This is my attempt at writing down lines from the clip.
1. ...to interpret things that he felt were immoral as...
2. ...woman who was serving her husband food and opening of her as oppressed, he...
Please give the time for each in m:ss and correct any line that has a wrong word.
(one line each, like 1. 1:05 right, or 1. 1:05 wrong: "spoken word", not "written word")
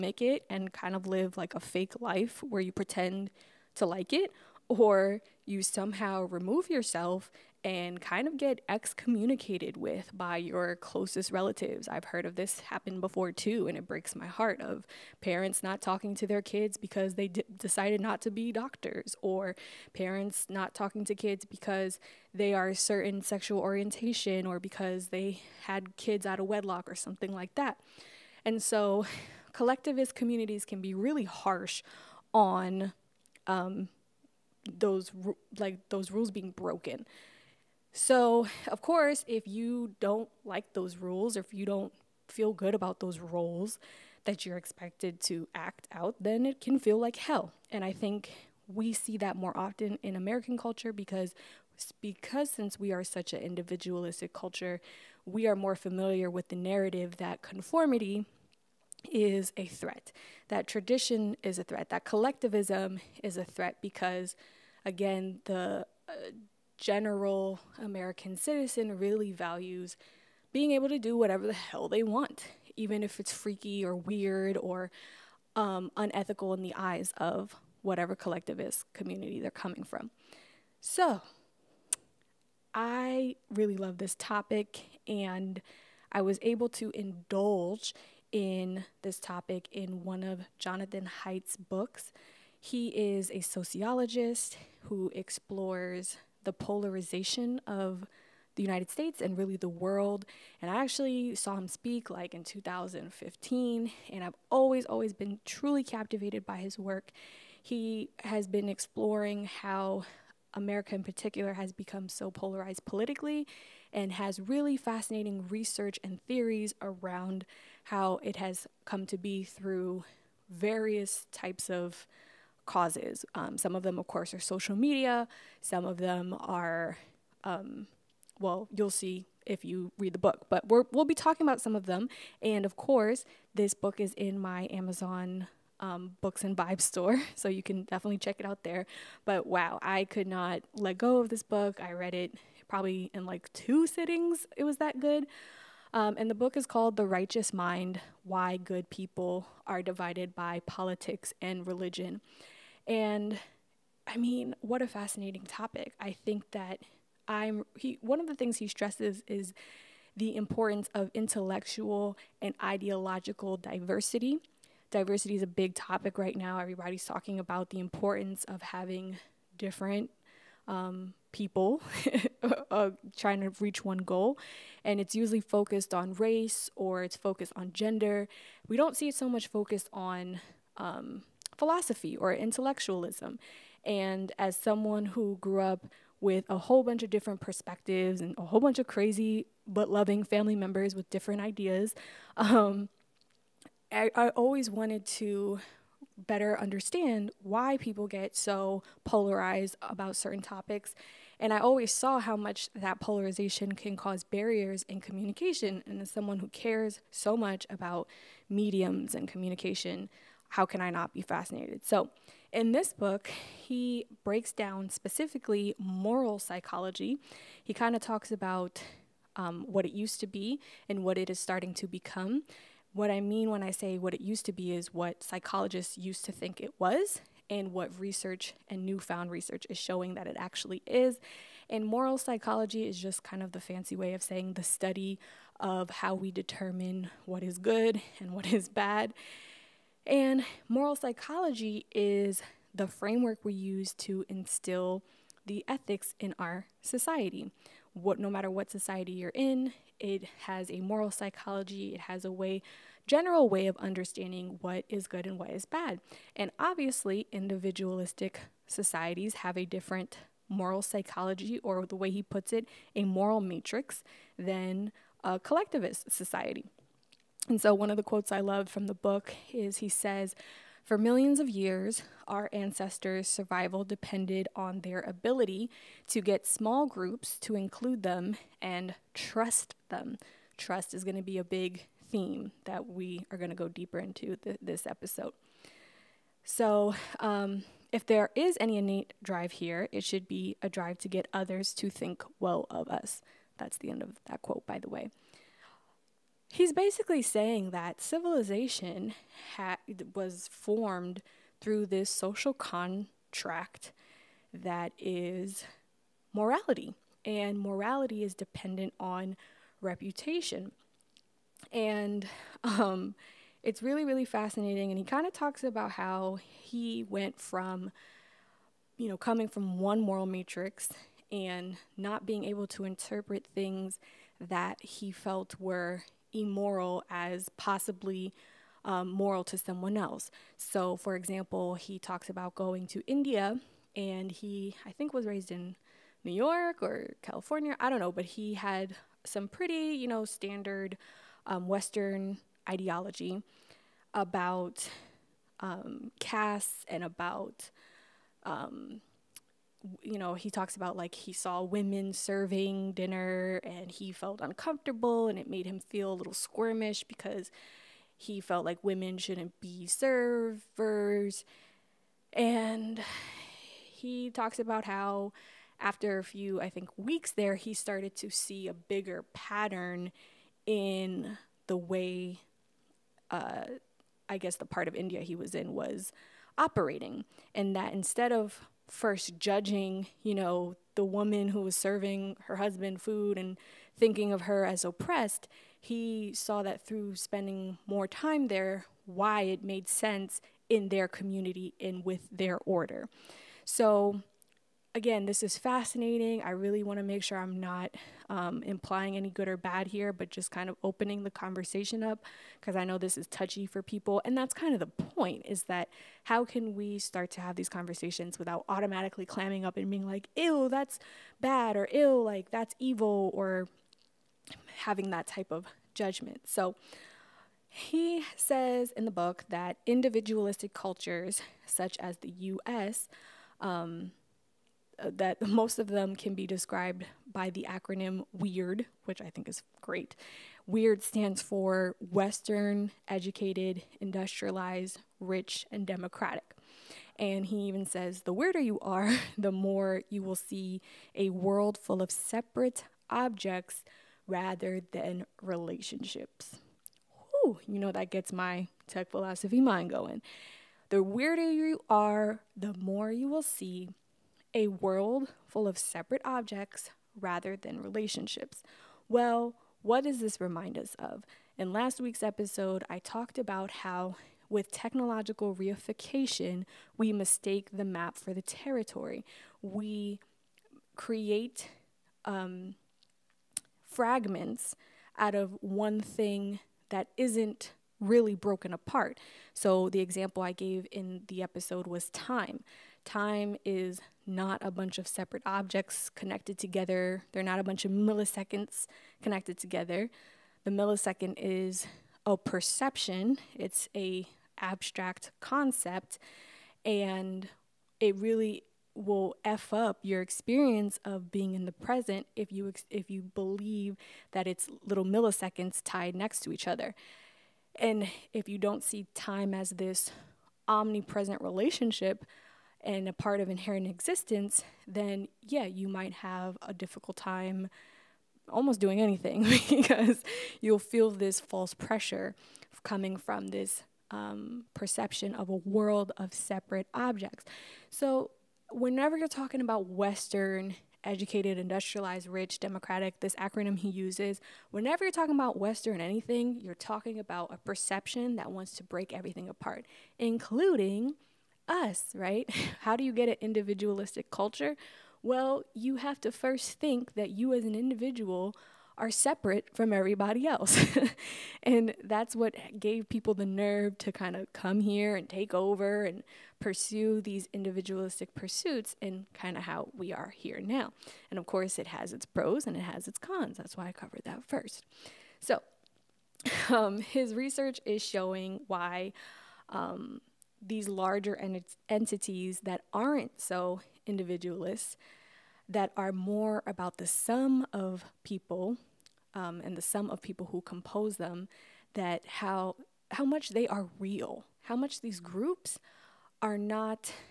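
1. 5:22 right
2. 6:21 wrong: "thinking", not "opening".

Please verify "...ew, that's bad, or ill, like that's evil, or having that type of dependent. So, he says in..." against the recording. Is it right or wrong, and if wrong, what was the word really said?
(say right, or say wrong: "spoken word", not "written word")
wrong: "judgment", not "dependent".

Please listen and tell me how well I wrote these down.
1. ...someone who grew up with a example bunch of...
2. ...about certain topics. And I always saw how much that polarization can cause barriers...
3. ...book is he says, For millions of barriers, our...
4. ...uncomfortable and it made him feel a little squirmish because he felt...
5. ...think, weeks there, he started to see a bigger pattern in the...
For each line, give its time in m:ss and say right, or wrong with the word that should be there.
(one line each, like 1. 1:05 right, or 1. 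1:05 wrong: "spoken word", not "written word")
1. 3:04 wrong: "whole", not "example"
2. 3:19 right
3. 4:28 wrong: "years", not "barriers"
4. 5:54 right
5. 6:06 right.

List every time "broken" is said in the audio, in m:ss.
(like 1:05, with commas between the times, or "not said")
0:36, 7:58.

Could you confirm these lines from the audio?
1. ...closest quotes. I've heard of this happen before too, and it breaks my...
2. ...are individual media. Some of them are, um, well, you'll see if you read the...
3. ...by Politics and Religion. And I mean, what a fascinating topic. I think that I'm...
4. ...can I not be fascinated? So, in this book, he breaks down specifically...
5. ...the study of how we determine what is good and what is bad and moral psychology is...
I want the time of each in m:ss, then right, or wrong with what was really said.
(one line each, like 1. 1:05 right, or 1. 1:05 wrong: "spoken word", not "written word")
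1. 0:10 wrong: "relatives", not "quotes"
2. 2:04 wrong: "social", not "individual"
3. 2:30 right
4. 3:30 right
5. 3:54 right.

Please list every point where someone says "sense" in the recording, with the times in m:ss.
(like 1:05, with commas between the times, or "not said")
6:29.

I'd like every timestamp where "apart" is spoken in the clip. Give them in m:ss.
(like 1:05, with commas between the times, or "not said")
7:58, 8:59.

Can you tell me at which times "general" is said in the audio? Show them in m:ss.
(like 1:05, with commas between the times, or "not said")
1:06, 4:13.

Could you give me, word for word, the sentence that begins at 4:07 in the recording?
What, no matter what society you're in, it has a moral psychology.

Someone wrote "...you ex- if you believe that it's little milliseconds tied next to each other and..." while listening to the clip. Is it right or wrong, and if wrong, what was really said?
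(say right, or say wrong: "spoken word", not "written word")
right.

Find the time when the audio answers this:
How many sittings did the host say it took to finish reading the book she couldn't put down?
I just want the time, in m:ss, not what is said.
2:23.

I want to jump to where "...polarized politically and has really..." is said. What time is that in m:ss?
1:52.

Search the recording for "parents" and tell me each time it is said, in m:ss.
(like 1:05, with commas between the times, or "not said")
0:15, 0:19.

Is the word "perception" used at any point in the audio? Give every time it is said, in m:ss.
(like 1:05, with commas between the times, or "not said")
8:12, 8:44, 8:57.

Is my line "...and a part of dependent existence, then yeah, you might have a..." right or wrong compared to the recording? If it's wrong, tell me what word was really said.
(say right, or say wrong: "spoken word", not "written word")
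wrong: "inherent", not "dependent".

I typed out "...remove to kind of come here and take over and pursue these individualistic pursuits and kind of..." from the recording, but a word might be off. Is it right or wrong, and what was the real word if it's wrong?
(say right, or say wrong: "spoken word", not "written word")
wrong: "nerve", not "remove".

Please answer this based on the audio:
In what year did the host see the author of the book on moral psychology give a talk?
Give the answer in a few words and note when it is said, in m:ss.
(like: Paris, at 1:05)
2015, at 1:42.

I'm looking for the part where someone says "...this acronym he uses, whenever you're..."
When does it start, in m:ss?
8:53.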